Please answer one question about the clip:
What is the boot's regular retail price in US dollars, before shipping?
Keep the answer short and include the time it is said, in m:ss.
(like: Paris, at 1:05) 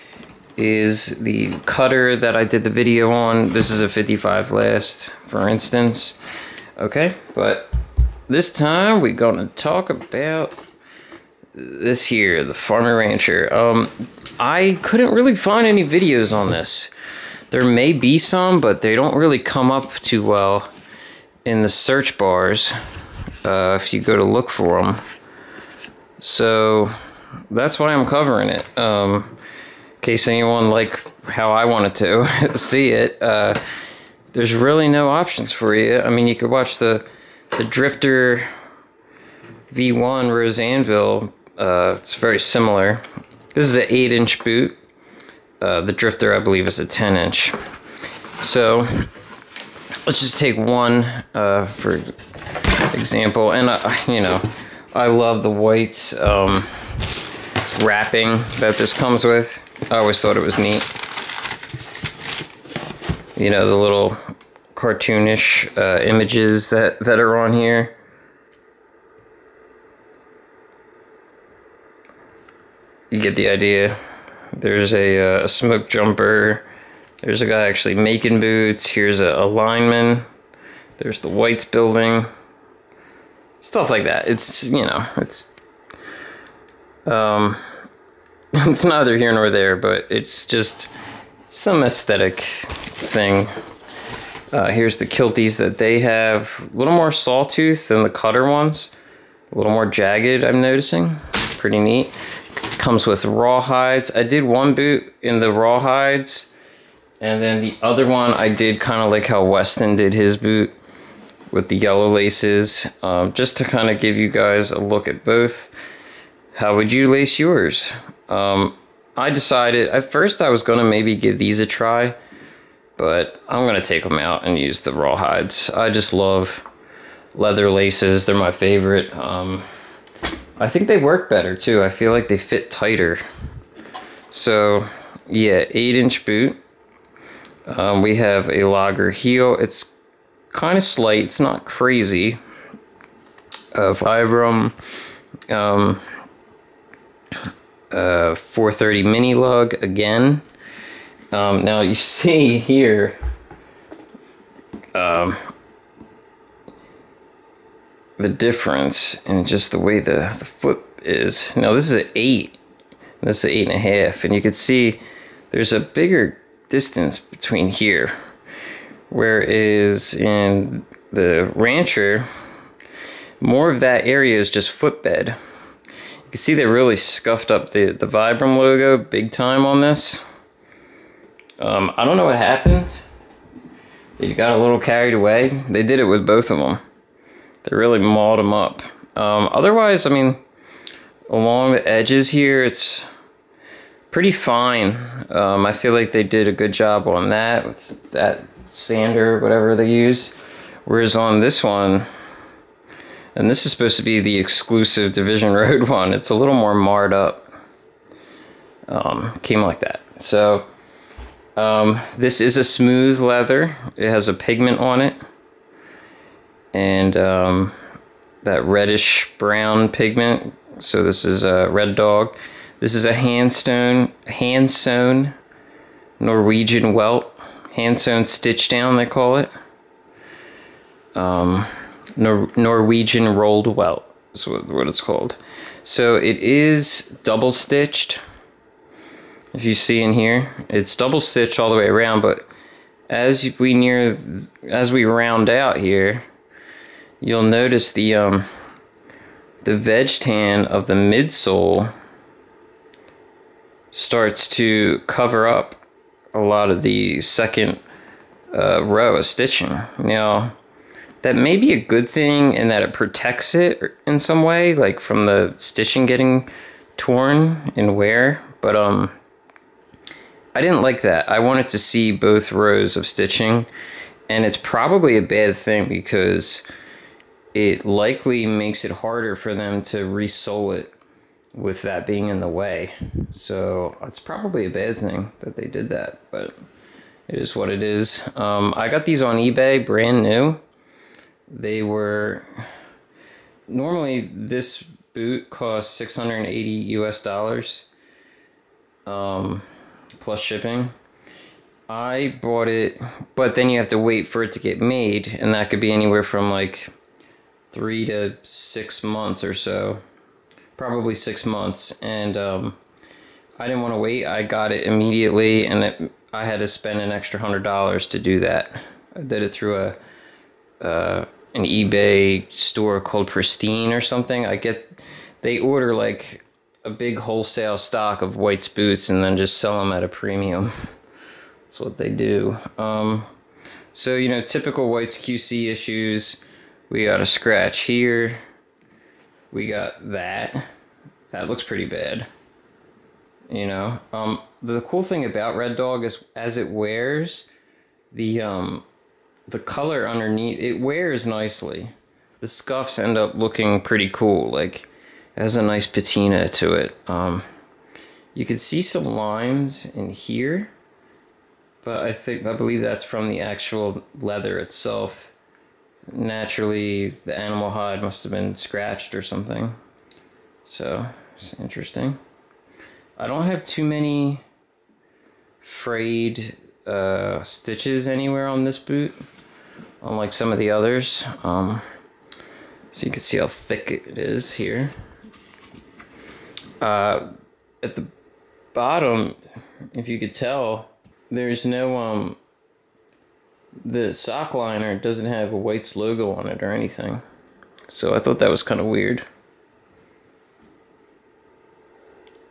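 $680, at 4:55.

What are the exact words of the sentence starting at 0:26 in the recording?
So that's why I'm covering it.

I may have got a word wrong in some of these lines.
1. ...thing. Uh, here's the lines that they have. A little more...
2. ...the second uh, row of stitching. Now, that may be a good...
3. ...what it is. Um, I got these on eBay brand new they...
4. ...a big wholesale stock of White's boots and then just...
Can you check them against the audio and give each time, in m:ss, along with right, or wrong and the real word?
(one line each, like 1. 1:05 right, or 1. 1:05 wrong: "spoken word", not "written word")
1. 1:32 wrong: "kilties", not "lines"
2. 4:16 right
3. 4:47 right
4. 5:26 right.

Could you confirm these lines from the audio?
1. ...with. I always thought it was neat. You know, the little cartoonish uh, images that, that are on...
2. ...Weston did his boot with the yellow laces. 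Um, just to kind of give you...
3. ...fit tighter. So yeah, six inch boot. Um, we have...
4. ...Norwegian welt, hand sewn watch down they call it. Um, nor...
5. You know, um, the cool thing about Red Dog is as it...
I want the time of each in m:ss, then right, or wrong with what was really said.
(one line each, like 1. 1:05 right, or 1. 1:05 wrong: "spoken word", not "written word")
1. 0:59 right
2. 1:49 right
3. 2:12 wrong: "eight", not "six"
4. 3:46 wrong: "stitch", not "watch"
5. 5:43 right.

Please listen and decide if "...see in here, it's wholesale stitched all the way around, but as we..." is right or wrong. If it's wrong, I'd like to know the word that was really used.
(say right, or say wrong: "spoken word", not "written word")
wrong: "double", not "wholesale".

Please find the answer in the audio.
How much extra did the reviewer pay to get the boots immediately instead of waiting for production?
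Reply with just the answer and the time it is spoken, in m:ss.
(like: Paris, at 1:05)
$100, at 5:17.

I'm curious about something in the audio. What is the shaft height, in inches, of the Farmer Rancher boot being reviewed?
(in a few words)
8-inch.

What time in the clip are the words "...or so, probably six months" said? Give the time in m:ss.
5:09.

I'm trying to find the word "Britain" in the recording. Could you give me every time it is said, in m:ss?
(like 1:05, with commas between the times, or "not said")
not said.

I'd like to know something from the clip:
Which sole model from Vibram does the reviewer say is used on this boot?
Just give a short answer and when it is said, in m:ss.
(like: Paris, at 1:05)
430 mini lug, at 2:27.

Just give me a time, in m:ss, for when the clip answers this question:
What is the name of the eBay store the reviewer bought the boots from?
5:23.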